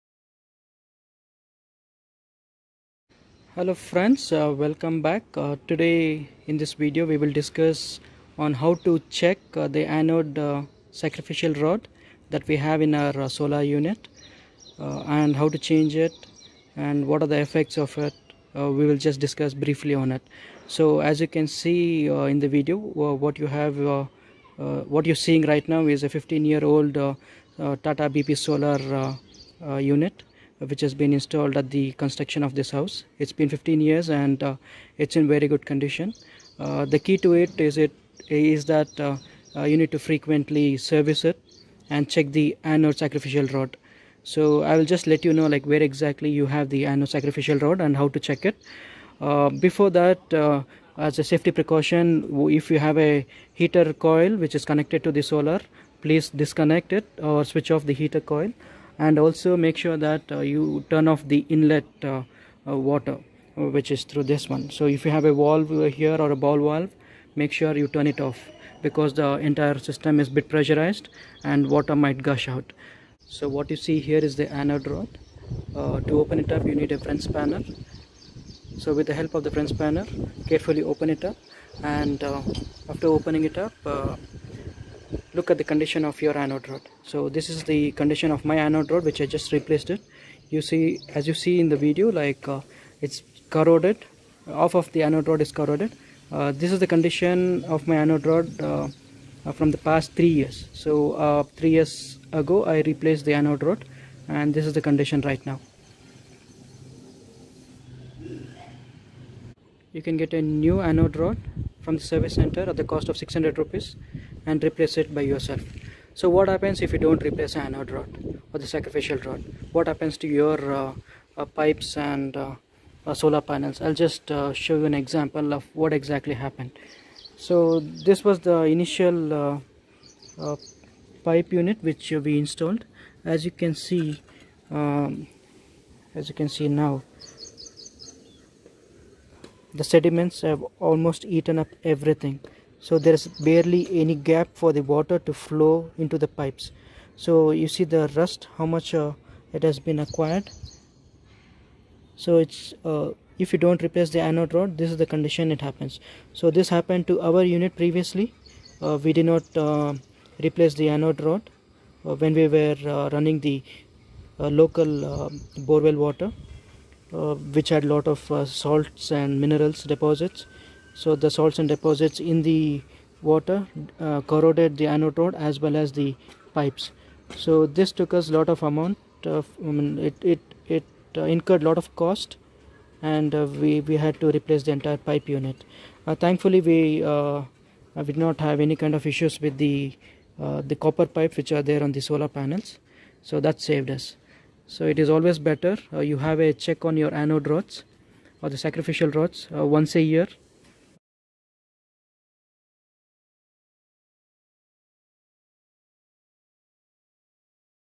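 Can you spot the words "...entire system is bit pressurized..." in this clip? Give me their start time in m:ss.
1:09.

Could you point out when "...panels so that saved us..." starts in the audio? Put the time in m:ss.
3:12.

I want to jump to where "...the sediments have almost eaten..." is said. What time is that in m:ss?
2:19.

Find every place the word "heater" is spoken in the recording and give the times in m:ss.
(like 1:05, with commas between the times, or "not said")
0:53, 0:57.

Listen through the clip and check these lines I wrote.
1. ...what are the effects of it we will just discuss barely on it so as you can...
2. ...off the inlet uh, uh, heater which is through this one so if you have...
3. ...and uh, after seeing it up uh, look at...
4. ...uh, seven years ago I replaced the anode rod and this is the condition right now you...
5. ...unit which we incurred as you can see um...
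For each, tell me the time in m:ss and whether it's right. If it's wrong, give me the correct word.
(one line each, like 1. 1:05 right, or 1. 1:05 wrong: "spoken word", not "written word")
1. 0:17 wrong: "briefly", not "barely"
2. 1:01 wrong: "water", not "heater"
3. 1:21 wrong: "opening", not "seeing"
4. 1:41 wrong: "three", not "seven"
5. 2:11 wrong: "installed", not "incurred".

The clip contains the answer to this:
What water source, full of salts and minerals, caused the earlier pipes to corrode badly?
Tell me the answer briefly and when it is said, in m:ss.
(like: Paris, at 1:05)
borewell water, at 2:45.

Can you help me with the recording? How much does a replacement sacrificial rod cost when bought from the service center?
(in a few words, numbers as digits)
600 rupees.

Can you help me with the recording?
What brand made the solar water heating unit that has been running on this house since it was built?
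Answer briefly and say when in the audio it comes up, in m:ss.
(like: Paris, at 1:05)
Tata BP, at 0:26.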